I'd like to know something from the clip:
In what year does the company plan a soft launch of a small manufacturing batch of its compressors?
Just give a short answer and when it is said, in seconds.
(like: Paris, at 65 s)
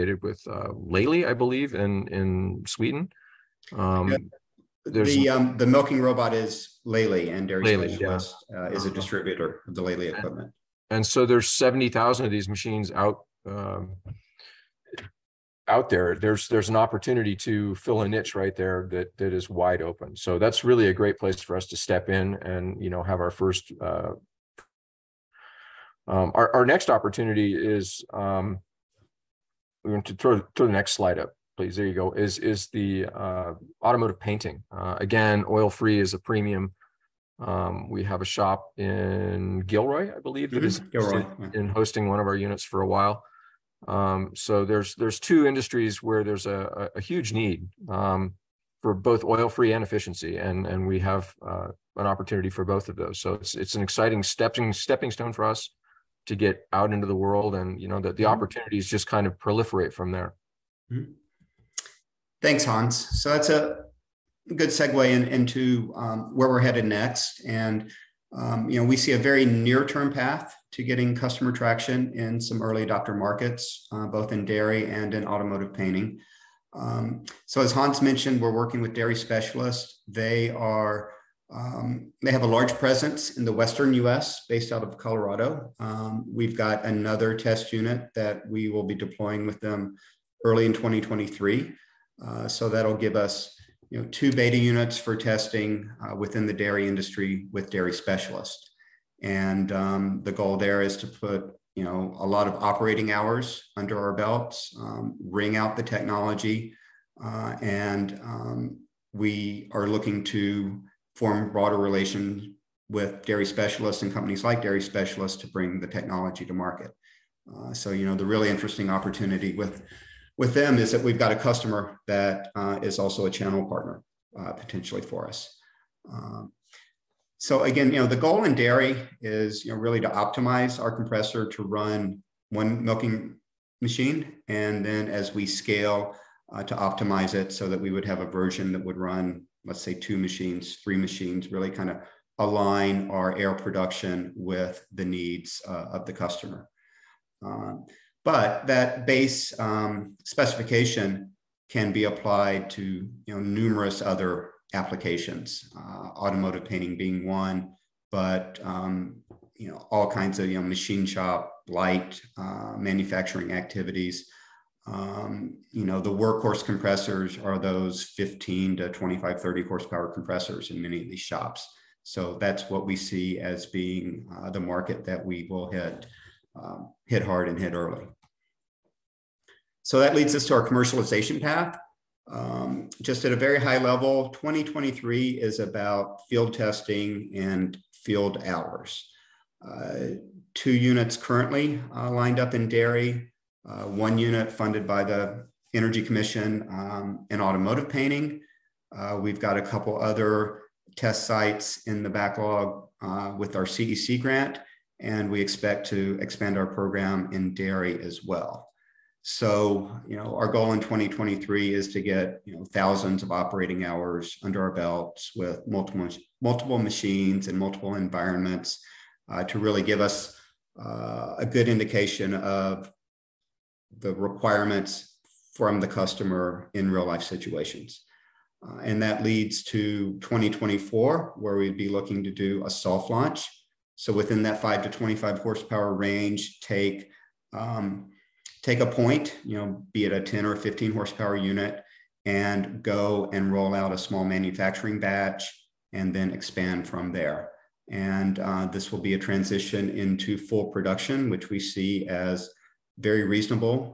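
2024, at 230 s.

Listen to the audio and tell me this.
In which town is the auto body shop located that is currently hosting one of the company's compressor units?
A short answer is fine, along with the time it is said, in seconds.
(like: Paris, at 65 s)
Gilroy, at 39 s.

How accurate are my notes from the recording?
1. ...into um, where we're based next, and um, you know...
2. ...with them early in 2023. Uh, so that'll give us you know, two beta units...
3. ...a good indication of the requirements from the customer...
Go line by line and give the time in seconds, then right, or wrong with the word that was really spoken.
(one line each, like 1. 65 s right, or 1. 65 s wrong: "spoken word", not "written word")
1. 65 s wrong: "headed", not "based"
2. 89 s right
3. 221 s right.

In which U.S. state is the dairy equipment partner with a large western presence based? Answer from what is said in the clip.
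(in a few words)
Colorado.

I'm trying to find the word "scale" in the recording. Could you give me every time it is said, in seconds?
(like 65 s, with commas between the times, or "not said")
135 s.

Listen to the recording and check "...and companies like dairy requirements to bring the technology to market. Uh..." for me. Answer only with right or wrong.
wrong.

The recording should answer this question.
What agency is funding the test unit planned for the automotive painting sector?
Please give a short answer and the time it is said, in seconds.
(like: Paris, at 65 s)
Energy Commission, at 195 s.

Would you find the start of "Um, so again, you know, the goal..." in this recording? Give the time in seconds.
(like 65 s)
126 s.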